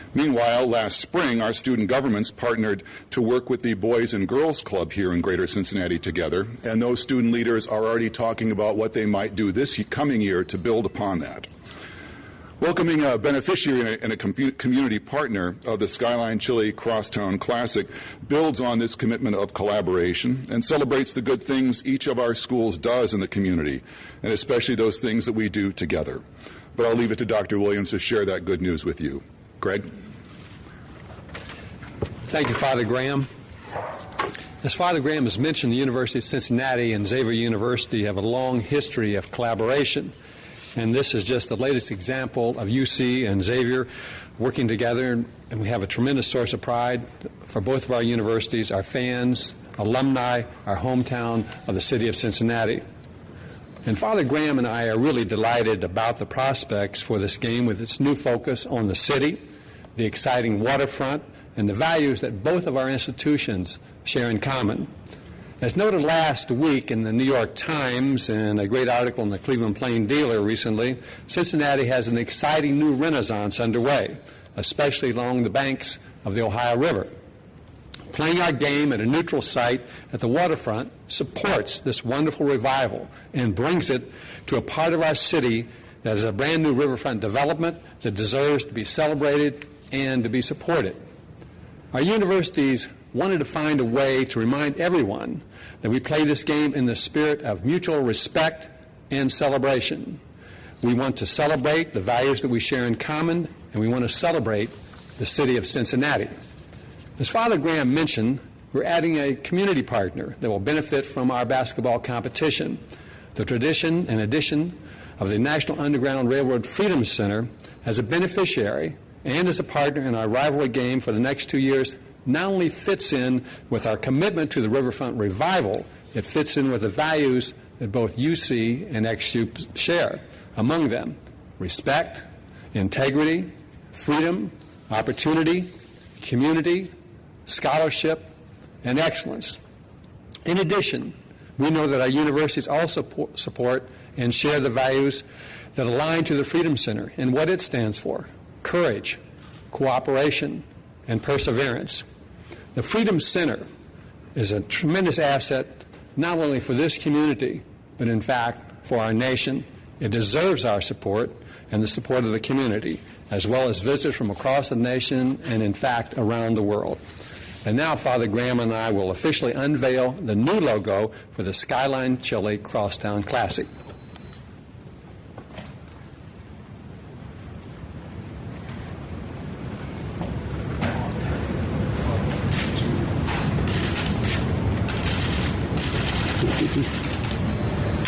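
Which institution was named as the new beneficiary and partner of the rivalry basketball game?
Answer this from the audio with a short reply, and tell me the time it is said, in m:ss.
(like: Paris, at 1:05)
National Underground Railroad Freedom Center, at 1:55.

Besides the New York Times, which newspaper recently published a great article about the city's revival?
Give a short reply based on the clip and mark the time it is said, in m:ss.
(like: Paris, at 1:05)
Cleveland Plain Dealer, at 1:09.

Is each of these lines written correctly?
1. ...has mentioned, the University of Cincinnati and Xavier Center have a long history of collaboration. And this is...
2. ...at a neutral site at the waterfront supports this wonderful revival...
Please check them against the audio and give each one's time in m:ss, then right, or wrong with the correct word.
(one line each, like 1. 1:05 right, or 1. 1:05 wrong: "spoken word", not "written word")
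1. 0:35 wrong: "University", not "Center"
2. 1:18 right.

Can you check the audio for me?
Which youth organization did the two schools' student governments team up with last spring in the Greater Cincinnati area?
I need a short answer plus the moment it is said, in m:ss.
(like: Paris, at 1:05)
Boys and Girls Club, at 0:03.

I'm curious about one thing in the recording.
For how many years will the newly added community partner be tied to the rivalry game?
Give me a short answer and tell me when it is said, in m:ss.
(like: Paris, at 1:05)
2, at 2:01.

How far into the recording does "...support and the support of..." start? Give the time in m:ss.
2:40.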